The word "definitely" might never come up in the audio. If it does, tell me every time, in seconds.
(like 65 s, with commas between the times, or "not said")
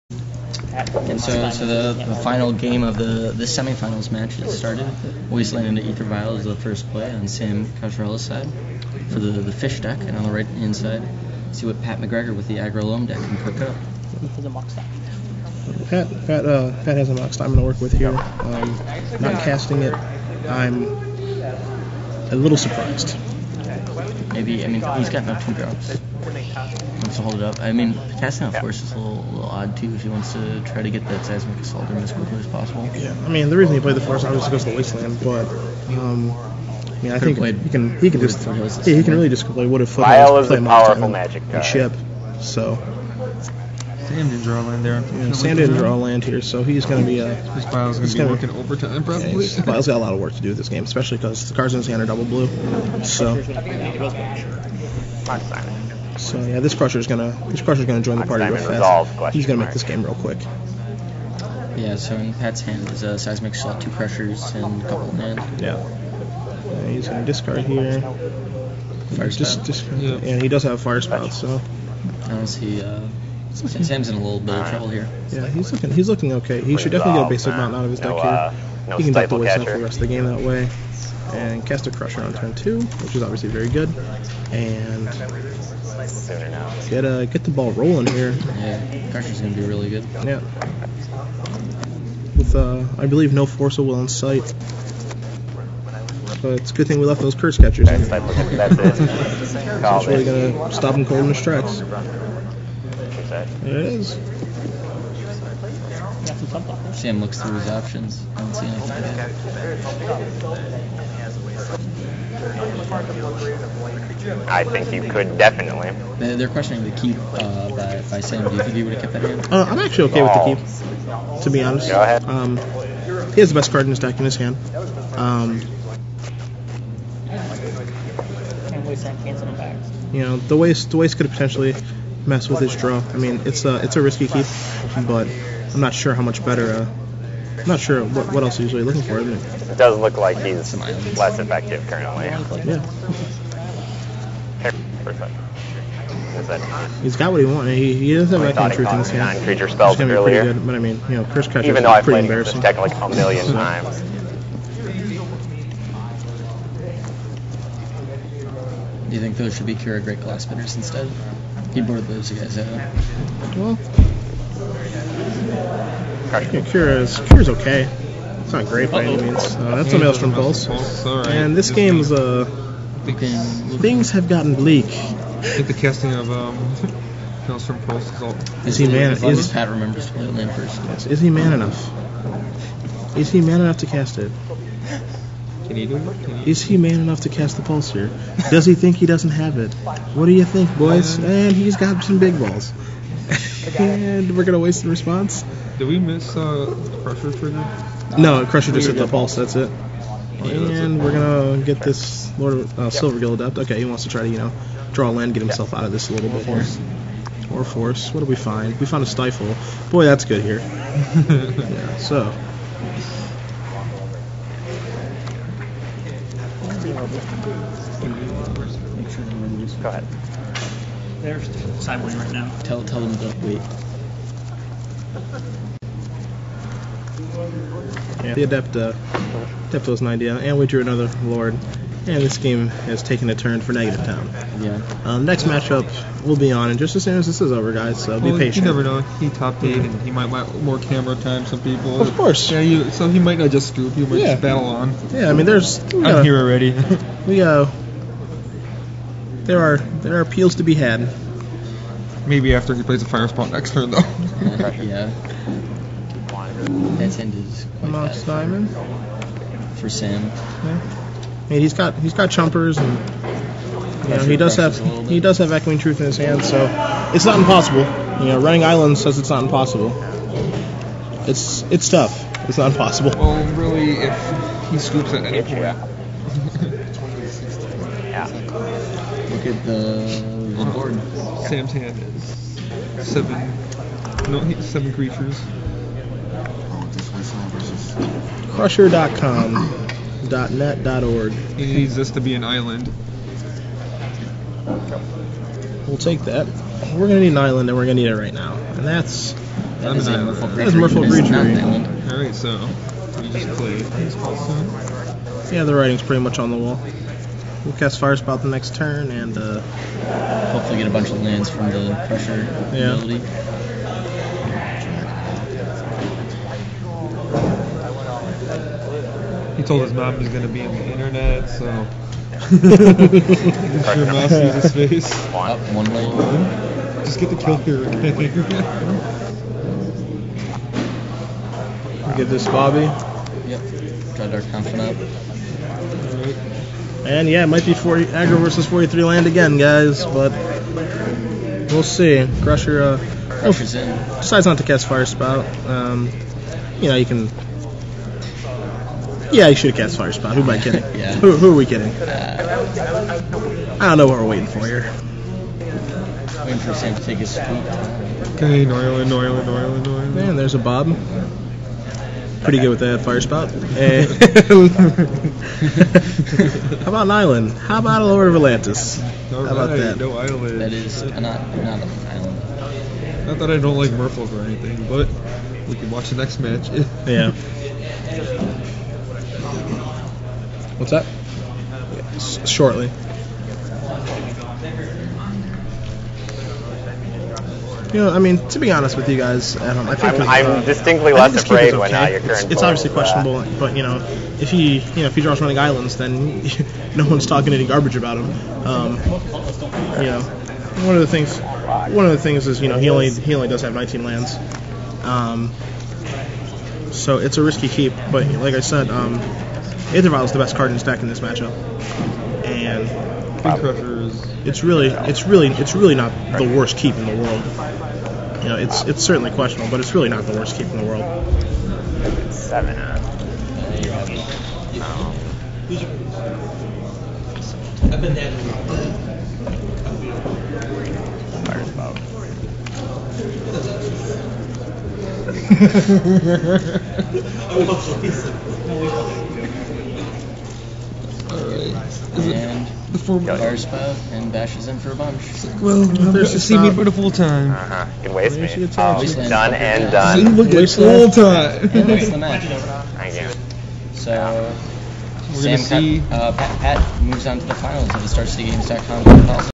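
76 s, 115 s.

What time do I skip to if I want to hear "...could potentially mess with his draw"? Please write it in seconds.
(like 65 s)
131 s.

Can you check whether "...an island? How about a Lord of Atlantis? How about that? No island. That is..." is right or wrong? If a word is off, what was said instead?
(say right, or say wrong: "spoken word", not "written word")
right.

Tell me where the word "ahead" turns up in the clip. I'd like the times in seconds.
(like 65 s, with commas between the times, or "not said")
122 s, 219 s.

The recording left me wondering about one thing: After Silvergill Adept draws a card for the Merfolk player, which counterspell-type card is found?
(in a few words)
Stifle.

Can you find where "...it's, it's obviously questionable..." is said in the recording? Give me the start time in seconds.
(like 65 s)
392 s.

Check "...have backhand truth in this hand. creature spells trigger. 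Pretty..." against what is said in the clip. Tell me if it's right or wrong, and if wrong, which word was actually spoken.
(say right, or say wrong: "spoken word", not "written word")
wrong: "earlier", not "trigger".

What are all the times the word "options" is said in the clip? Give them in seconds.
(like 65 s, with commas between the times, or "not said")
107 s.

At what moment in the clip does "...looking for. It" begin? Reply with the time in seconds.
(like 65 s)
138 s.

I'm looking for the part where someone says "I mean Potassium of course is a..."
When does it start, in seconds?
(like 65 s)
27 s.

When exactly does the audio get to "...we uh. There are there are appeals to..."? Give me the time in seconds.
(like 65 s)
247 s.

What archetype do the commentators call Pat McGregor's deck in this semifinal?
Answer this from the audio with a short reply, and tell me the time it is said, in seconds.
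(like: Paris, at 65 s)
aggro loam, at 12 s.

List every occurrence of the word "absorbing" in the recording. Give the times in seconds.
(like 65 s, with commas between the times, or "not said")
not said.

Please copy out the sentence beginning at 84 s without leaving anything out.
And get a uh, get the ball rolling here.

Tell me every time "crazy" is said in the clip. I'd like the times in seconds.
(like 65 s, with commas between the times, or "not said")
not said.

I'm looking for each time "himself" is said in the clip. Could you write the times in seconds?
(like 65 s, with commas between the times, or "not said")
205 s.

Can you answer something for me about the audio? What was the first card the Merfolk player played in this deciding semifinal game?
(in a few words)
Aether Vial.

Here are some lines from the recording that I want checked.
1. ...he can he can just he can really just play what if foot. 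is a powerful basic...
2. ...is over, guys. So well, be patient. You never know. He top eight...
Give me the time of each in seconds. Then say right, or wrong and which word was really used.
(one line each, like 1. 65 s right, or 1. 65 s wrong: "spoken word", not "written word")
1. 37 s wrong: "magic", not "basic"
2. 237 s right.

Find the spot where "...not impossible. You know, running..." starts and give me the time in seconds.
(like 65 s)
267 s.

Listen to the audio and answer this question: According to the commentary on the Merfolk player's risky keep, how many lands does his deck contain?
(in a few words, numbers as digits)
19.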